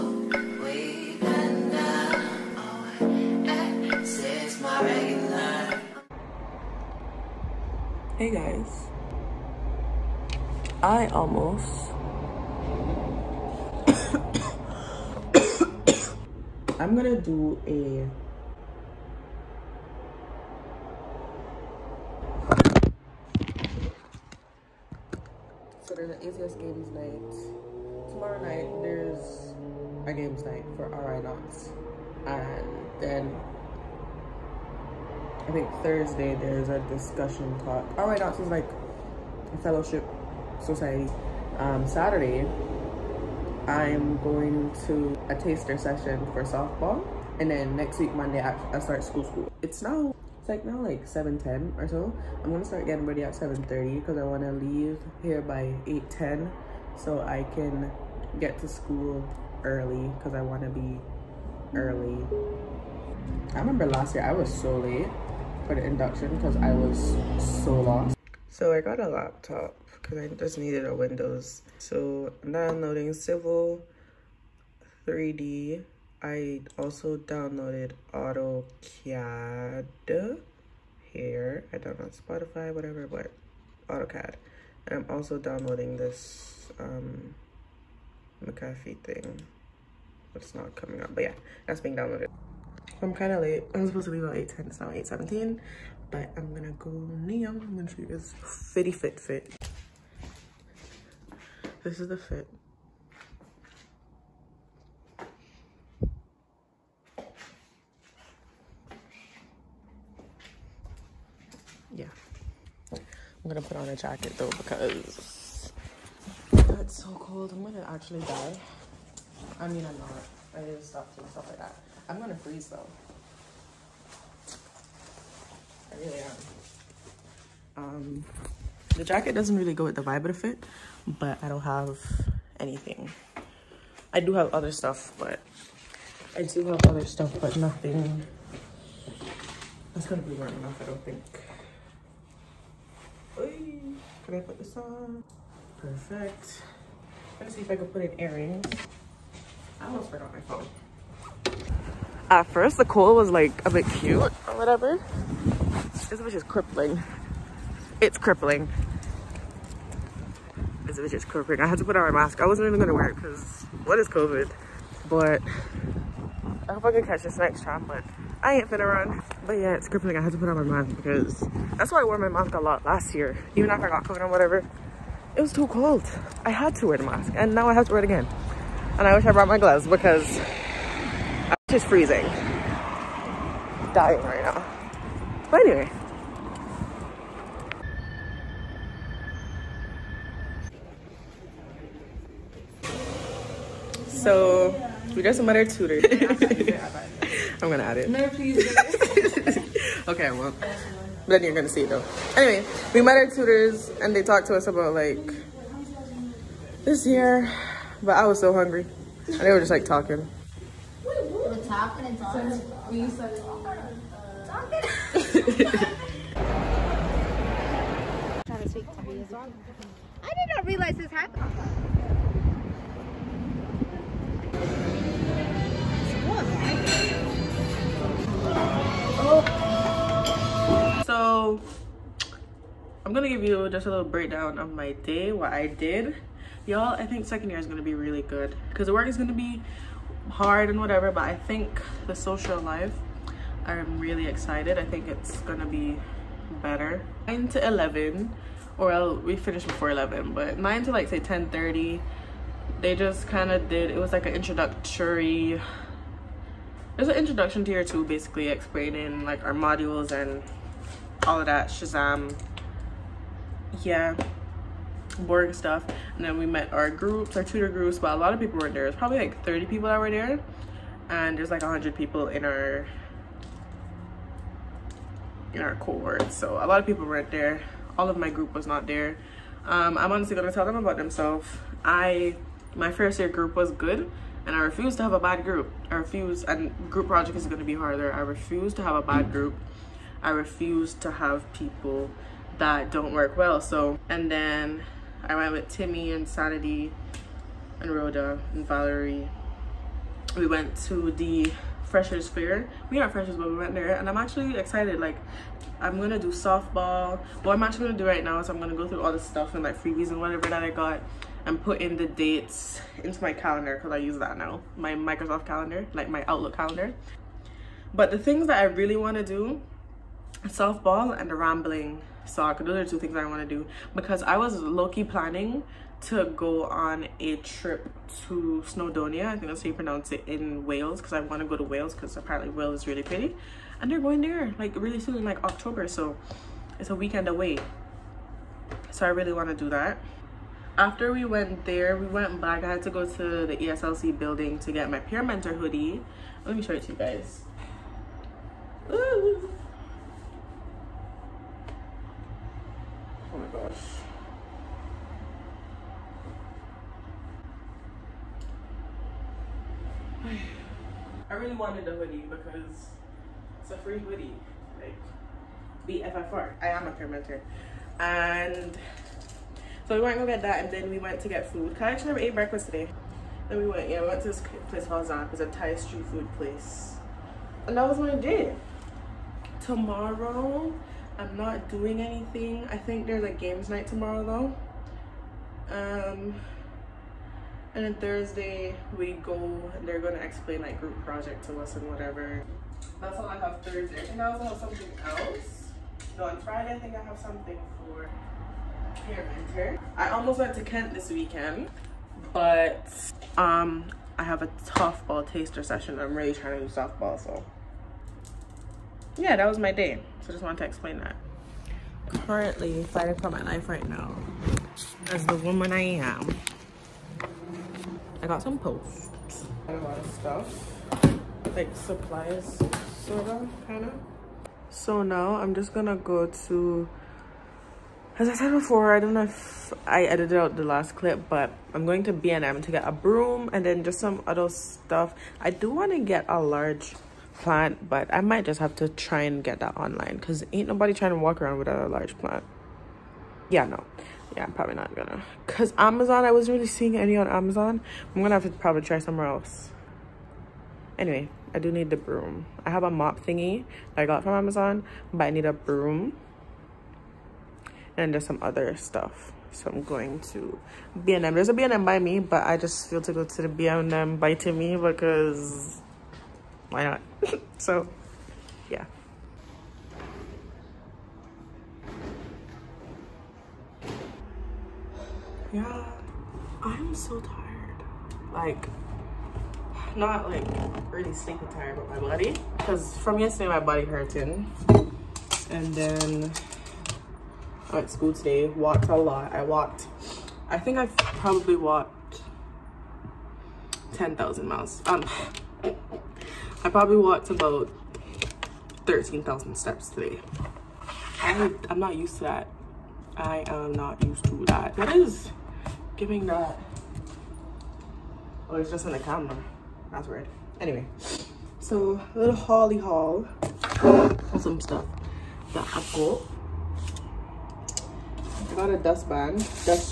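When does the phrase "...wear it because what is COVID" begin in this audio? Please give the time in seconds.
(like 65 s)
162 s.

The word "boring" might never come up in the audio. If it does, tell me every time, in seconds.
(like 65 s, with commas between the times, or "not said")
265 s.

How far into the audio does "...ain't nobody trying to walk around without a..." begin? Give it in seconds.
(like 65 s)
440 s.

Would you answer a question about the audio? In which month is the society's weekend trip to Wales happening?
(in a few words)
October.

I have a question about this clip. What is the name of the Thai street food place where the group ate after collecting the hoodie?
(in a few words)
Zaap.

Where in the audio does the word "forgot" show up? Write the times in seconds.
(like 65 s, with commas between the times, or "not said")
150 s.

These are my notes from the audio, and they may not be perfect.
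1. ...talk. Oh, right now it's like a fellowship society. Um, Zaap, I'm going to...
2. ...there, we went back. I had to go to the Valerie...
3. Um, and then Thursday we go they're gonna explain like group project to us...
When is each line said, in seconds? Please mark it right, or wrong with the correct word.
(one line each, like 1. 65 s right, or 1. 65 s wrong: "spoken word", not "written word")
1. 37 s wrong: "Saturday", not "Zaap"
2. 341 s wrong: "ESLC", not "Valerie"
3. 386 s right.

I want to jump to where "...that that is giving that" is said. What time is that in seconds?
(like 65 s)
504 s.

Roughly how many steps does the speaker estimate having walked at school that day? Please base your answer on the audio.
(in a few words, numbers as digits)
13,000.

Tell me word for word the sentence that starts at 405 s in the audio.
I'm really trying to do softball, so yeah, that was my day.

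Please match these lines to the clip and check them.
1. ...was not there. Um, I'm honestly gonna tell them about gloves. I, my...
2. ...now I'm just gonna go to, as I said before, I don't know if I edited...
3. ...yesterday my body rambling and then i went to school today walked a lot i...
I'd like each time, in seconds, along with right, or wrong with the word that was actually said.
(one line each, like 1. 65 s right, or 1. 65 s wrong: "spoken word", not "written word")
1. 278 s wrong: "themselves", not "gloves"
2. 425 s right
3. 483 s wrong: "hurting", not "rambling".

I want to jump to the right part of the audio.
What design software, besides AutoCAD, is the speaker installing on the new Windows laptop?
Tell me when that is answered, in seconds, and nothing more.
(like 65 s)
73 s.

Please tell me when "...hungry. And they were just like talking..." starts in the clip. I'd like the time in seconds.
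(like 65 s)
208 s.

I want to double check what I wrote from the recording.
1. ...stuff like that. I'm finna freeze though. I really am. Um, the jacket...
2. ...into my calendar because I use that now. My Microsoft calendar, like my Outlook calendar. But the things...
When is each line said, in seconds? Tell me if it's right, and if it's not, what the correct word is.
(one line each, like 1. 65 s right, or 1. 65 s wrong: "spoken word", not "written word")
1. 121 s wrong: "gonna", not "finna"
2. 313 s right.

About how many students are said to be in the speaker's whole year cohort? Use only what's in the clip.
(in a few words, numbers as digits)
100.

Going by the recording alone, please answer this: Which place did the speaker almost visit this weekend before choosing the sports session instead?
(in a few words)
Kent.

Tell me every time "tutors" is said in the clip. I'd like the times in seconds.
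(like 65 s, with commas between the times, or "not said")
195 s, 203 s, 267 s.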